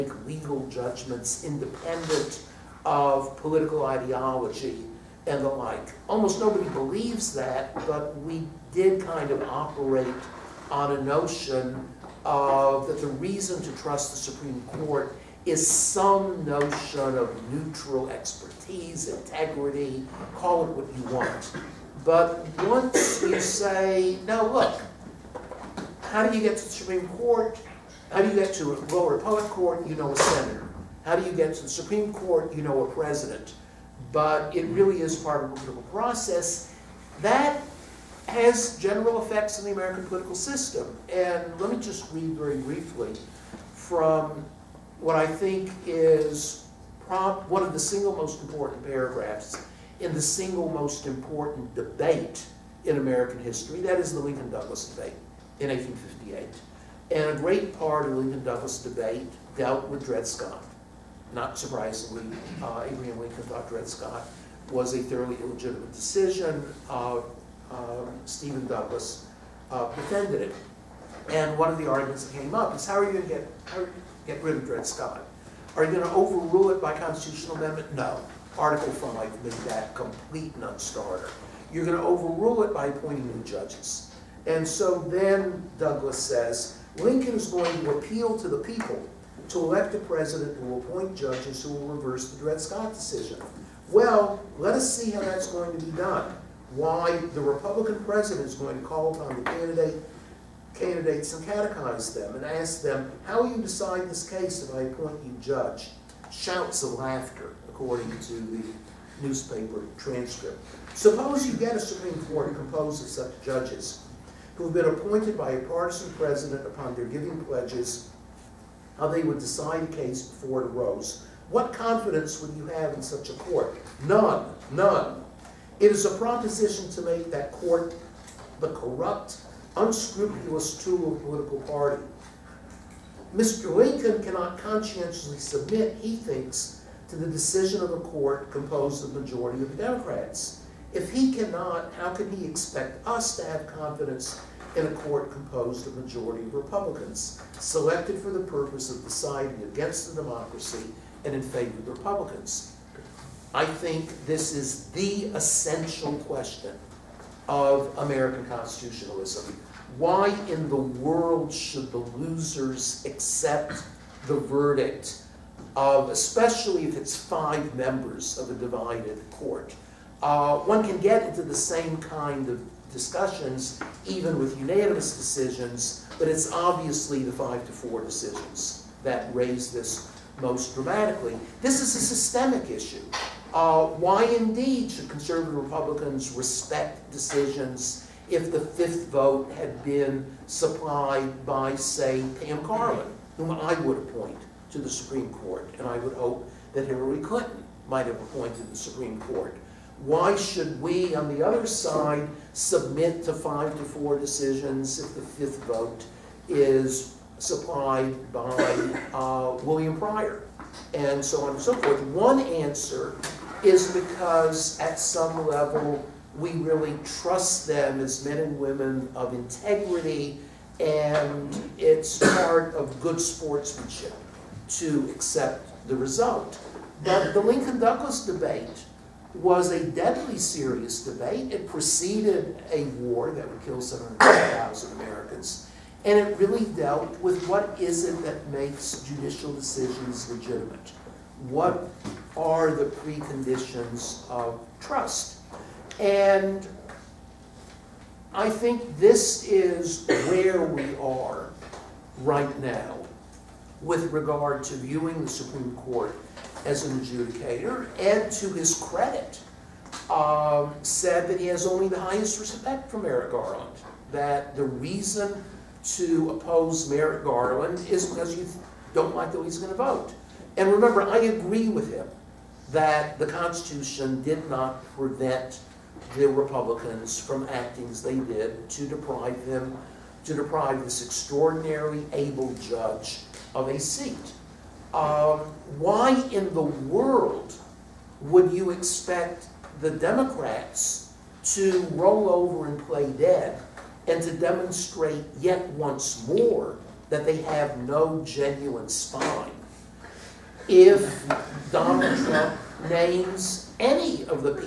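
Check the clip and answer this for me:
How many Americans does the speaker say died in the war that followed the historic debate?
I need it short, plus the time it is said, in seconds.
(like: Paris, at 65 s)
700,000, at 233 s.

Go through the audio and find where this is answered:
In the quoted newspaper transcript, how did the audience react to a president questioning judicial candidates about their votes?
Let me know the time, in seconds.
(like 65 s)
106 s.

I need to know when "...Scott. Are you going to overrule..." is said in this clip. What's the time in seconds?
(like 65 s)
74 s.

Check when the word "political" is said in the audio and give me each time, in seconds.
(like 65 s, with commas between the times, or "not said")
3 s, 35 s, 40 s, 131 s.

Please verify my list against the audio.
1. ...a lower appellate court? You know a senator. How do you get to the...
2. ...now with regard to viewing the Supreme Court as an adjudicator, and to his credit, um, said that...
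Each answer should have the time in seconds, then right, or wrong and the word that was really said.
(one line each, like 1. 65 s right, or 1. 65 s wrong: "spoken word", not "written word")
1. 28 s right
2. 252 s right.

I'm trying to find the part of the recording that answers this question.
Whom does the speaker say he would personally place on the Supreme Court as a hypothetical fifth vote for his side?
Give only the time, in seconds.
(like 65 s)
192 s.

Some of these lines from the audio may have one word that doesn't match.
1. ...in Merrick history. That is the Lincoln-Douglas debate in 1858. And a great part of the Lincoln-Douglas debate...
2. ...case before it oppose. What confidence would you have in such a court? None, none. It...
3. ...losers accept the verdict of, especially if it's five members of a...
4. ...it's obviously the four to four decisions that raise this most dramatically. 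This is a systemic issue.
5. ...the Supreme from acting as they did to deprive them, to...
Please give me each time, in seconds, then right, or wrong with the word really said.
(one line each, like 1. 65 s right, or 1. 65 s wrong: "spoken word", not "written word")
1. 52 s wrong: "American", not "Merrick"
2. 119 s wrong: "arose", not "oppose"
3. 161 s right
4. 176 s wrong: "five", not "four"
5. 276 s wrong: "Republicans", not "Supreme".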